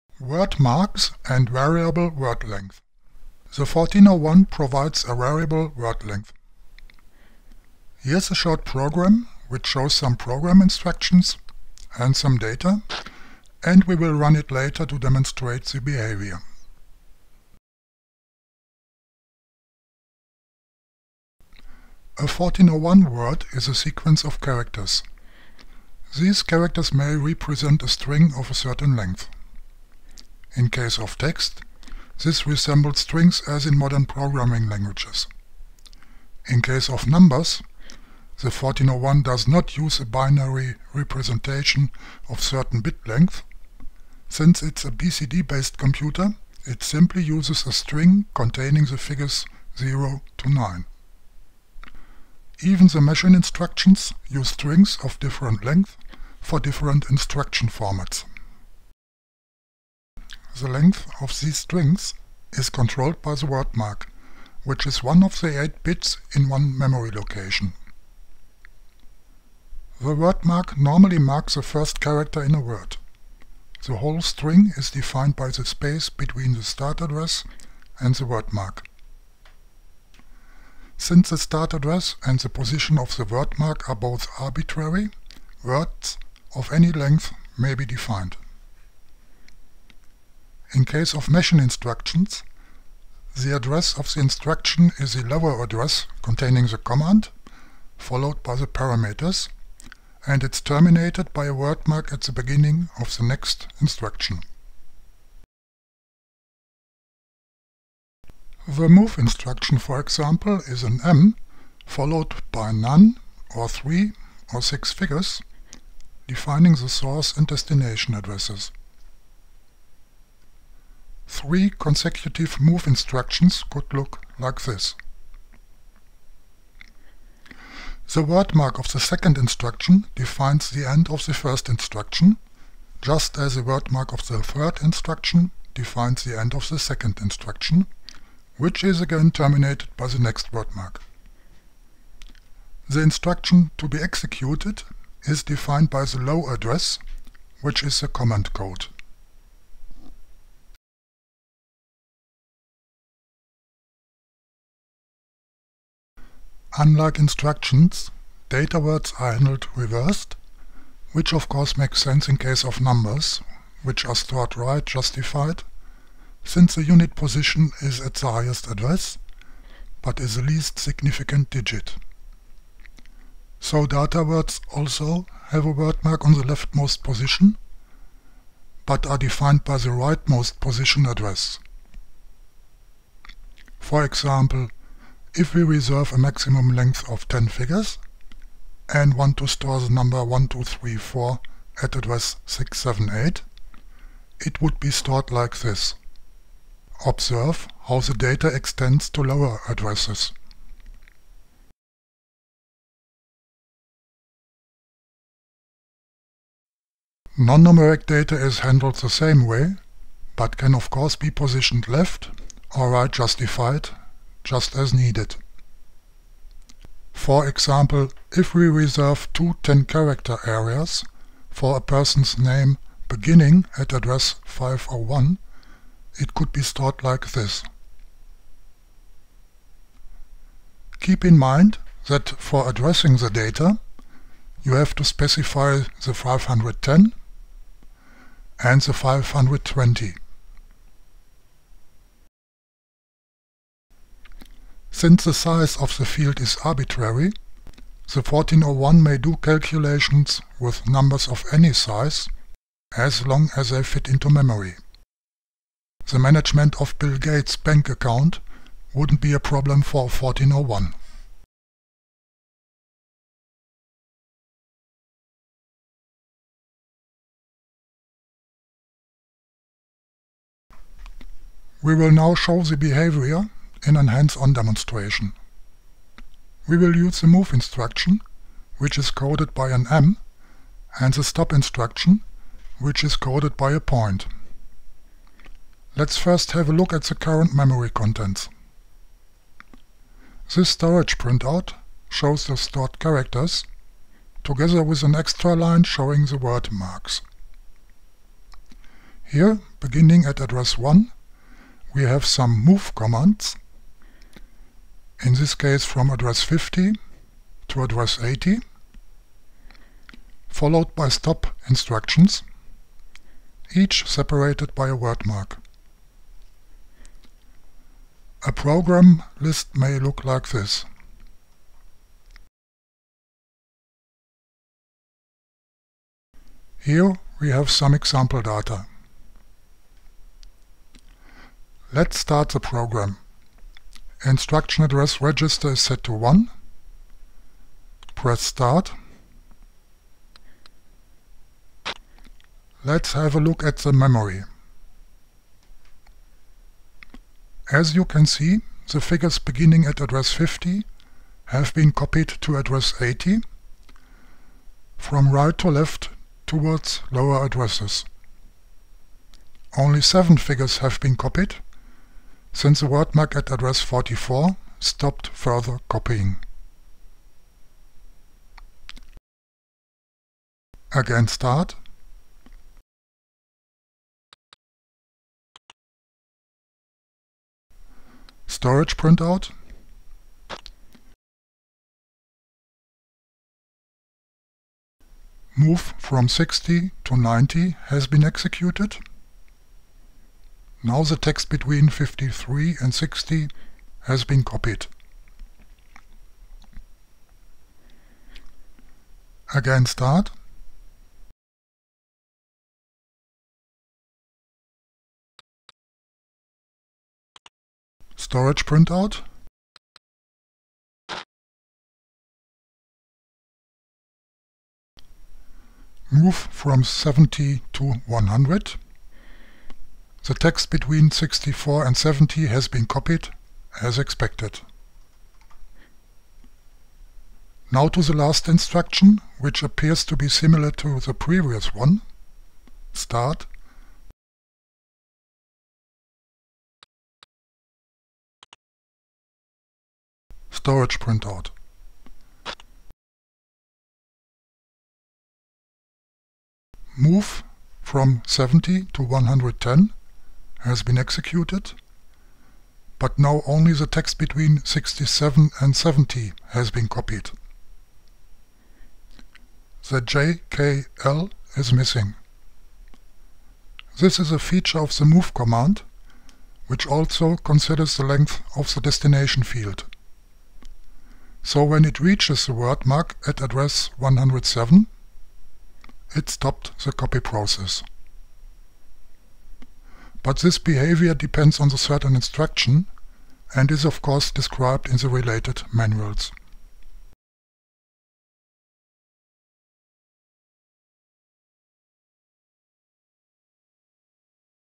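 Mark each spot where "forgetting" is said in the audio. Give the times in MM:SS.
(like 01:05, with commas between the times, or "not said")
not said.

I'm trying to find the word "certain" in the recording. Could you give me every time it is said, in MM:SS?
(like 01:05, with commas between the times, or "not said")
00:28, 00:42, 08:01.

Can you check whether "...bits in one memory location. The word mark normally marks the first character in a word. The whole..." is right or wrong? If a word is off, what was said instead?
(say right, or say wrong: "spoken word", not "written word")
right.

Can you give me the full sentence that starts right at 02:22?
The instruction to be executed is defined by the low address, which is the command code.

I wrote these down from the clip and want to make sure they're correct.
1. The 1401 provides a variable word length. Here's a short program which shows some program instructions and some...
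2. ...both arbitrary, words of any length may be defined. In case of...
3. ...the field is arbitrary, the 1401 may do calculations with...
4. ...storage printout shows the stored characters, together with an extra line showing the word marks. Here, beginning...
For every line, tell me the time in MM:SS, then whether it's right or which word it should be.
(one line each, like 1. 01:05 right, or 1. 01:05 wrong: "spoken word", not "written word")
1. 00:03 right
2. 01:23 right
3. 04:05 right
4. 04:50 right.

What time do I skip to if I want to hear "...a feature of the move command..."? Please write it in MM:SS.
07:44.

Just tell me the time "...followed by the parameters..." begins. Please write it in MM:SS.
01:37.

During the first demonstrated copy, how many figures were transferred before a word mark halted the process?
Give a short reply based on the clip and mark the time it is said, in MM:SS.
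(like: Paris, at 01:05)
7, at 06:00.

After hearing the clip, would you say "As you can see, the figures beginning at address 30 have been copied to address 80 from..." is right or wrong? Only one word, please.
wrong.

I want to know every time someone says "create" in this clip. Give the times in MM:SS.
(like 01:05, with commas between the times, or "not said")
not said.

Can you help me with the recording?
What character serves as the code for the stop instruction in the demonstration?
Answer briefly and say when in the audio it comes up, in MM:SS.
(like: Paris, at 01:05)
a point, at 04:43.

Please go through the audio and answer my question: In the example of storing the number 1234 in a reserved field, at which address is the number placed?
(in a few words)
678.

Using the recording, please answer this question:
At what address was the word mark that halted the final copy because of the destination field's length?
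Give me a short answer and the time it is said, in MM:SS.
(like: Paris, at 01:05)
107, at 07:53.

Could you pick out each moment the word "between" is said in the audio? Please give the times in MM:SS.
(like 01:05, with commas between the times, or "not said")
01:16, 06:31, 07:00, 07:34.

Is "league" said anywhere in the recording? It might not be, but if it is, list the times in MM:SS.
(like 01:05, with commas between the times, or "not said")
not said.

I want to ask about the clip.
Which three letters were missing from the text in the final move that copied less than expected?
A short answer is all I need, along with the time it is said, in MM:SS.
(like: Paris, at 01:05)
JKL, at 07:40.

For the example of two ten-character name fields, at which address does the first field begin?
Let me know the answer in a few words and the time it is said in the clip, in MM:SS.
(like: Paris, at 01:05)
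501, at 03:44.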